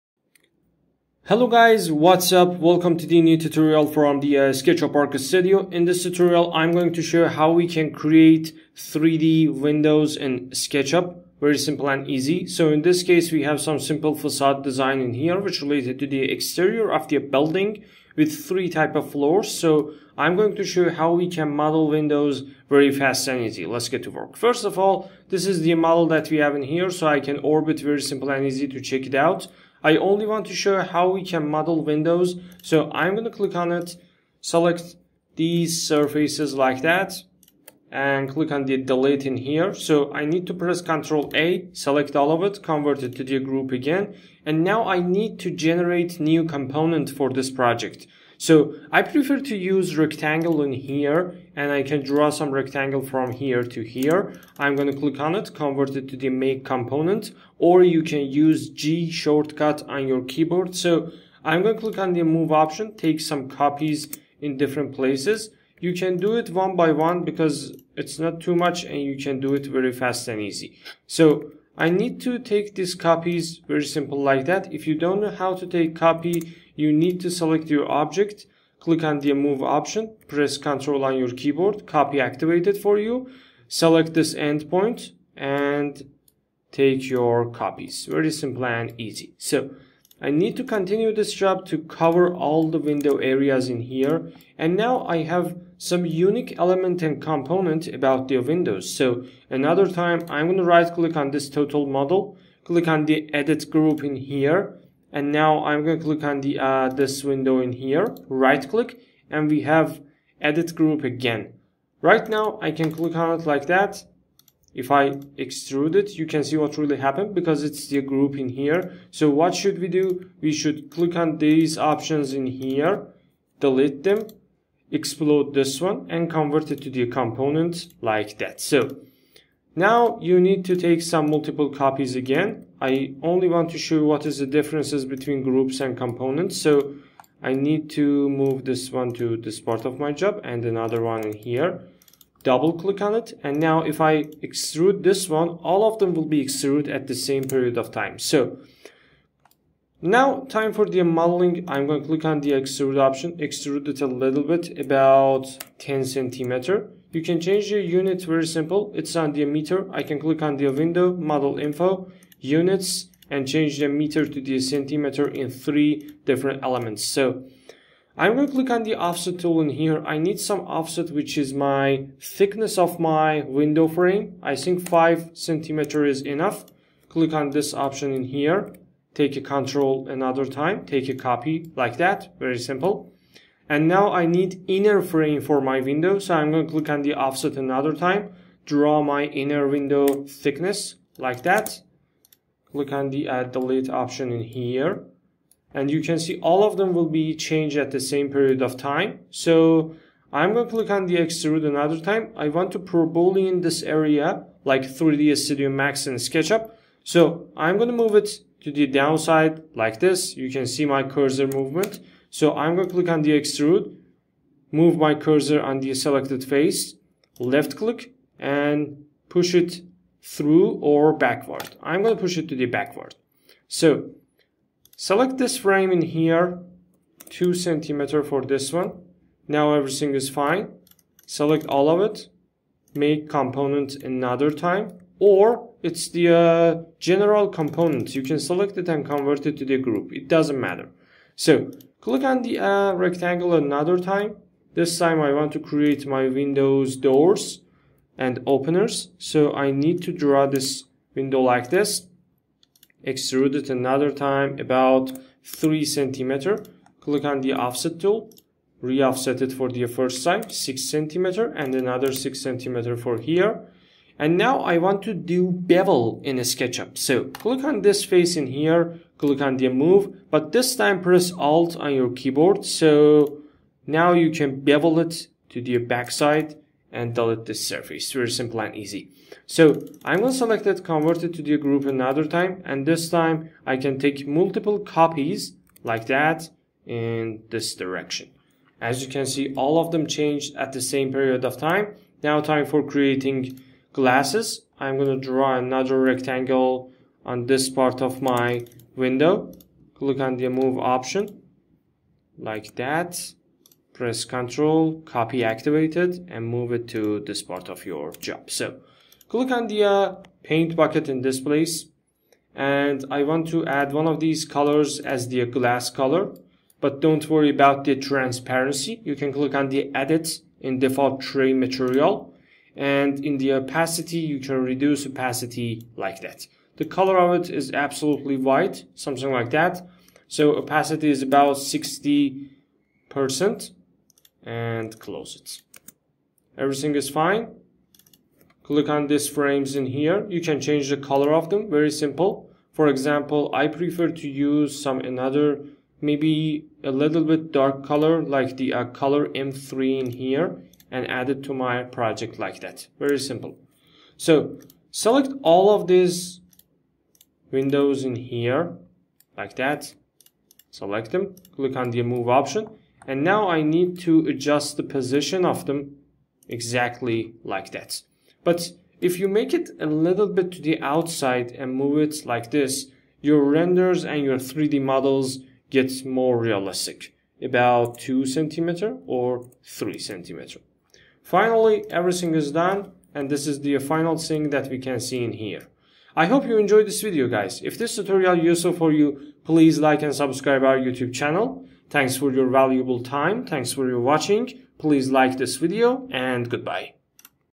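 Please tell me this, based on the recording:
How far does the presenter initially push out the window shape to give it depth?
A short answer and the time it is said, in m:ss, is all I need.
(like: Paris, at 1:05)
10 centimeter, at 2:34.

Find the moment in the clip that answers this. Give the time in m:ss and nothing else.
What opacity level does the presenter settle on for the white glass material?
5:31.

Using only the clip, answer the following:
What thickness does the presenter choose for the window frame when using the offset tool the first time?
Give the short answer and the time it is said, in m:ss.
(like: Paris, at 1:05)
5 centimeters, at 2:54.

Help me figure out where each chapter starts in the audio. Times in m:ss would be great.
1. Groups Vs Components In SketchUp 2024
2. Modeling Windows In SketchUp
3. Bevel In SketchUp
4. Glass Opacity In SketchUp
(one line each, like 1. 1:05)
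1. 0:54
2. 2:07
3. 4:22
4. 5:26.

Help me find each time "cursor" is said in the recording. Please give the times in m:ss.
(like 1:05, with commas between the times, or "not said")
3:31, 3:35.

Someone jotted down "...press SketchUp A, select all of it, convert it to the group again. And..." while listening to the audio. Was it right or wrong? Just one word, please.
wrong.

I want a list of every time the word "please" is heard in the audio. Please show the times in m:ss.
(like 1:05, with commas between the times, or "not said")
6:29, 6:34.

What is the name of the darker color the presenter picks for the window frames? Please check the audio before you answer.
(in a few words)
color M3.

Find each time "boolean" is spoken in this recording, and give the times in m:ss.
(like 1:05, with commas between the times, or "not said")
3:23.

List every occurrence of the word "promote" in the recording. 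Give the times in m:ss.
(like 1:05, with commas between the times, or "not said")
not said.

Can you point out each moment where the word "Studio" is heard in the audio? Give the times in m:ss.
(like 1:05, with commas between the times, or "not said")
0:05, 3:25.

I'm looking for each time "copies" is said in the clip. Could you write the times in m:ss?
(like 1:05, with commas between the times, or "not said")
1:03, 1:12, 1:27, 2:11, 4:44.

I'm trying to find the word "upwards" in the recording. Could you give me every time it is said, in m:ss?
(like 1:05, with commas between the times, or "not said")
not said.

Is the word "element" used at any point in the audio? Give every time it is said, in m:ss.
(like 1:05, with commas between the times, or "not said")
1:36, 2:46.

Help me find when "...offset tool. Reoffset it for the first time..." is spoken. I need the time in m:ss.
4:17.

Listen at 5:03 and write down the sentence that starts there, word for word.
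Press control, copy activated and move it to this part of your job.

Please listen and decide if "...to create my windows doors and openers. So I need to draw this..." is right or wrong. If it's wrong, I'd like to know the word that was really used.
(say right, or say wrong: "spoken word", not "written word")
right.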